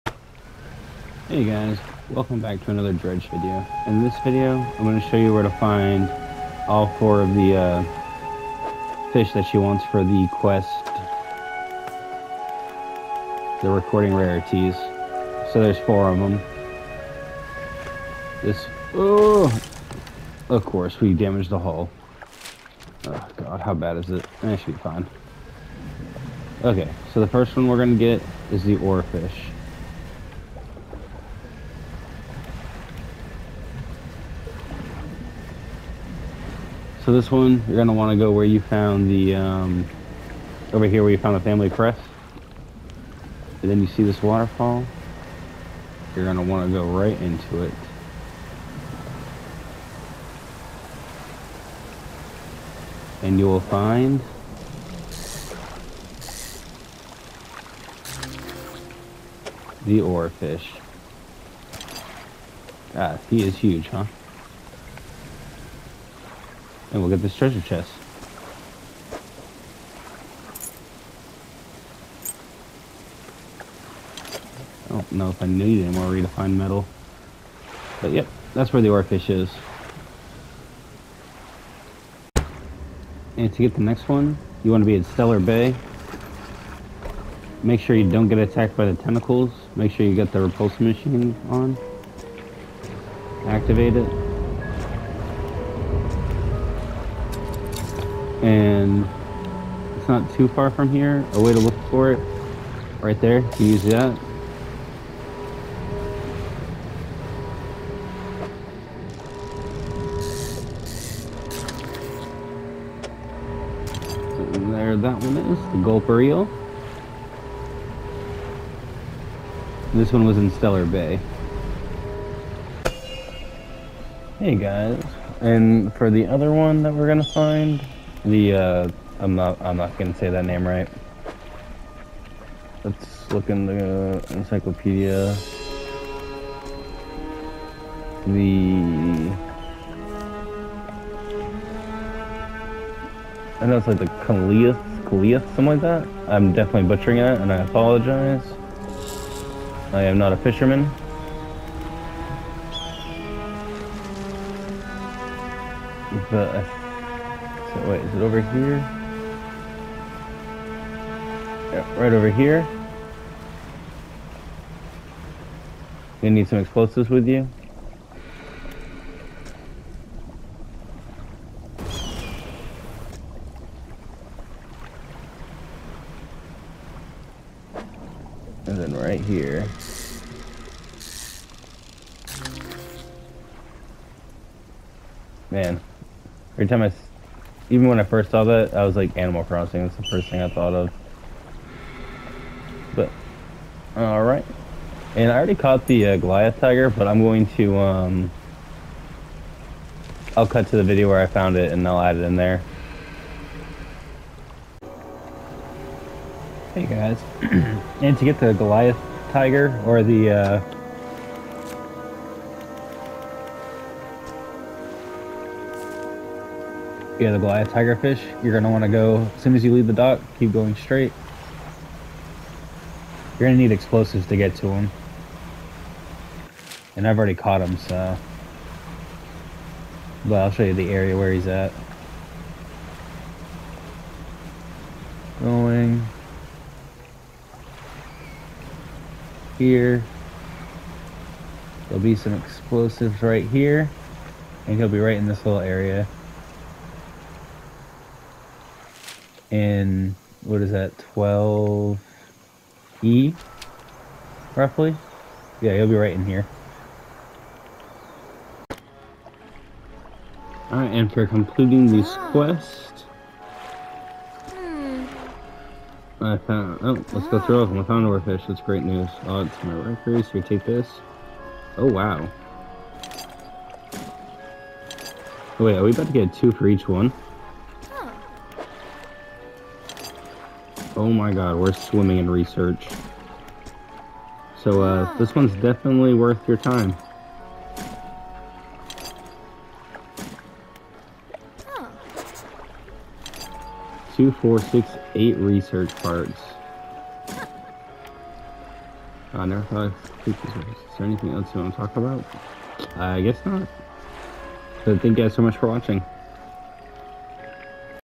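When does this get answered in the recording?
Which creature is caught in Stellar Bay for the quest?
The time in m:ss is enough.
1:55.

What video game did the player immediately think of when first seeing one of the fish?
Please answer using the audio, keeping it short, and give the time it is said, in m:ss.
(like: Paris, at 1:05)
Animal Crossing, at 3:09.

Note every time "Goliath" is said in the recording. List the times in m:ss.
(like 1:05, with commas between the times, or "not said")
3:16, 3:28, 3:37.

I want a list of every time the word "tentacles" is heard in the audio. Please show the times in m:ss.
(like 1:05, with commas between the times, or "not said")
1:29.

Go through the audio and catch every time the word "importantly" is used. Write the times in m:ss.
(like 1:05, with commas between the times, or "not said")
not said.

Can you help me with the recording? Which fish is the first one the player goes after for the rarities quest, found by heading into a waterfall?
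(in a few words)
Oarfish.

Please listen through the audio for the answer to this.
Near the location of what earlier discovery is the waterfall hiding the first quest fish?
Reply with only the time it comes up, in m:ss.
0:41.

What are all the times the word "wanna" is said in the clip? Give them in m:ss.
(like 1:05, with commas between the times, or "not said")
0:37, 0:46.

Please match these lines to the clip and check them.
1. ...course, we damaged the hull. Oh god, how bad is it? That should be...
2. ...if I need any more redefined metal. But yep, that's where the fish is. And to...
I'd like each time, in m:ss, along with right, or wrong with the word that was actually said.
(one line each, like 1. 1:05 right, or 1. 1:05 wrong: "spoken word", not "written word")
1. 0:20 right
2. 1:15 right.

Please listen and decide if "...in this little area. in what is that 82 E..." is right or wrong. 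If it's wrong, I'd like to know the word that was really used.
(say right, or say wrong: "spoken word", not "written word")
wrong: "12", not "82".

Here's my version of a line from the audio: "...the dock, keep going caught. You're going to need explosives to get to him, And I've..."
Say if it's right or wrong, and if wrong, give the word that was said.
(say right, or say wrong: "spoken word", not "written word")
wrong: "straight", not "caught".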